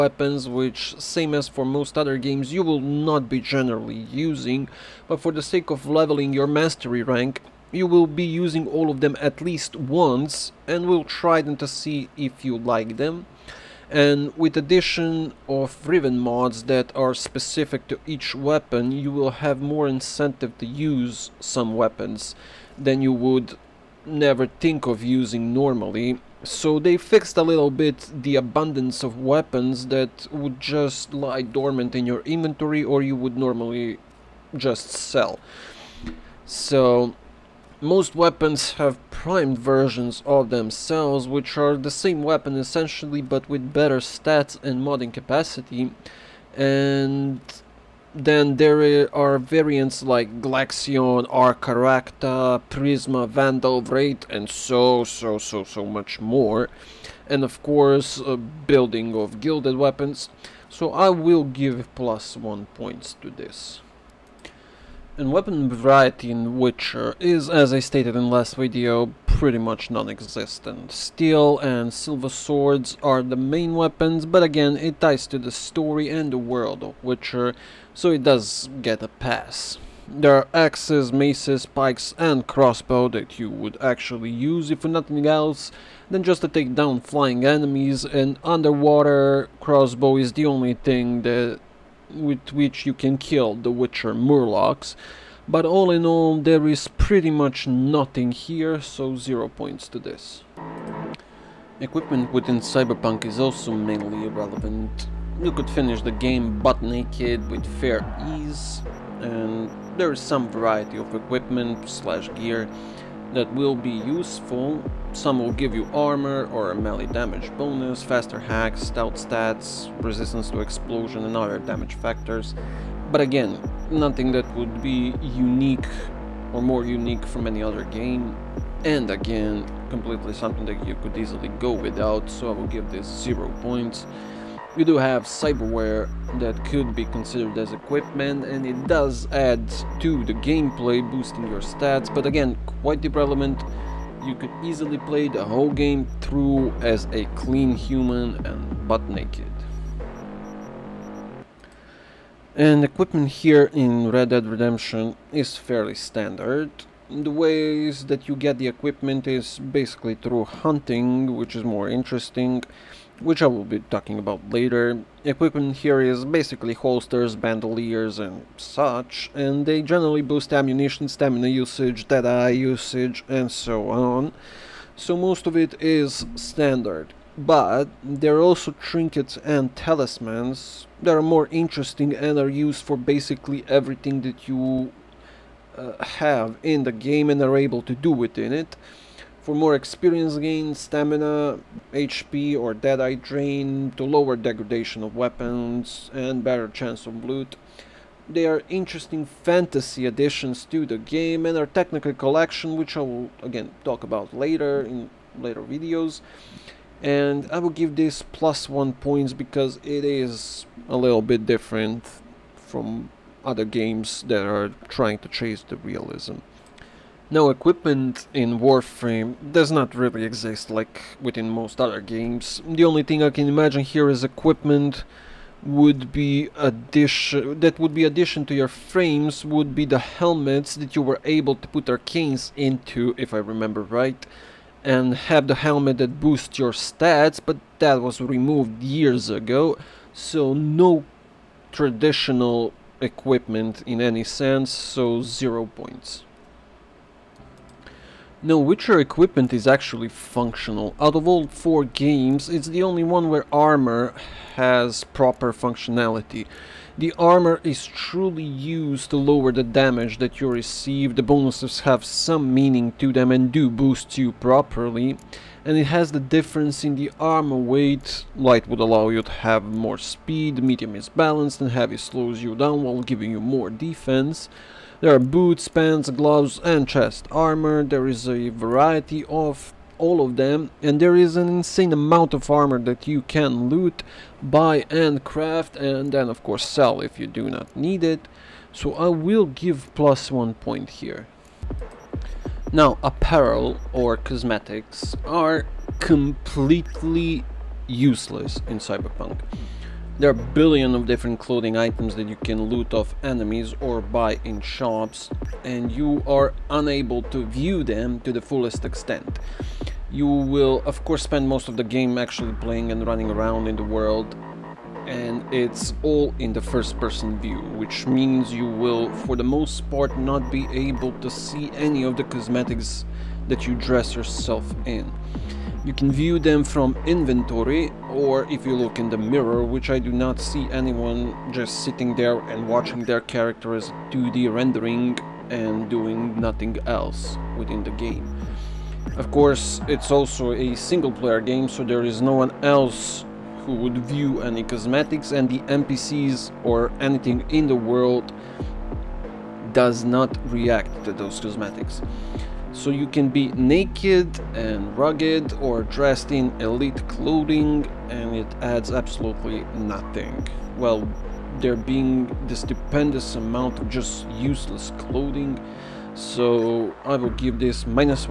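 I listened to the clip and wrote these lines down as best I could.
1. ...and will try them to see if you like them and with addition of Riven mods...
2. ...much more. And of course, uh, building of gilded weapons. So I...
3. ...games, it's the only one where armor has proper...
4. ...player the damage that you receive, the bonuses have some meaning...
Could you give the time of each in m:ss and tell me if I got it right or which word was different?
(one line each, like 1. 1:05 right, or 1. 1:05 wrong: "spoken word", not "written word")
1. 0:10 right
2. 0:55 right
3. 4:11 right
4. 4:19 wrong: "lower", not "player".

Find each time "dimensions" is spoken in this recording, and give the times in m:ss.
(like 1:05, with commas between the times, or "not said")
not said.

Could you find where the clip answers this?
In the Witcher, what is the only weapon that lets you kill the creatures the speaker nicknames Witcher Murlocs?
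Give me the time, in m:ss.
1:28.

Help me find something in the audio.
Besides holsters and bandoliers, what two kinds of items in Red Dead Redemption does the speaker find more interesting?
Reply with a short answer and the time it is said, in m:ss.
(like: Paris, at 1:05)
trinkets and talismans, at 2:58.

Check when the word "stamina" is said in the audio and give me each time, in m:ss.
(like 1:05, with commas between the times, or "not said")
2:51, 3:10.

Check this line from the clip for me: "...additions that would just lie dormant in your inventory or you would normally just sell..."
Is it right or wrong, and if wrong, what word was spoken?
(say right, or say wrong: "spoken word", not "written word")
wrong: "weapons", not "additions".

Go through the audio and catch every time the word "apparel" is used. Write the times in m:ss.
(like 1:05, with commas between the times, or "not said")
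4:53.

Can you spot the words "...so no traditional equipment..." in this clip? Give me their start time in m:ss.
4:00.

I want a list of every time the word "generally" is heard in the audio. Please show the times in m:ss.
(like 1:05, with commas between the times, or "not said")
0:03, 2:49.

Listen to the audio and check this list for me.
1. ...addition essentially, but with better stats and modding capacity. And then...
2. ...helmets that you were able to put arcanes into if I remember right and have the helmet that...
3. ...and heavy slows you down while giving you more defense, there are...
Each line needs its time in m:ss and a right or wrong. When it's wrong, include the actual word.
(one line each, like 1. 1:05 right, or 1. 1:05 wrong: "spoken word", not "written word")
1. 0:42 wrong: "weapon", not "addition"
2. 3:49 right
3. 4:31 right.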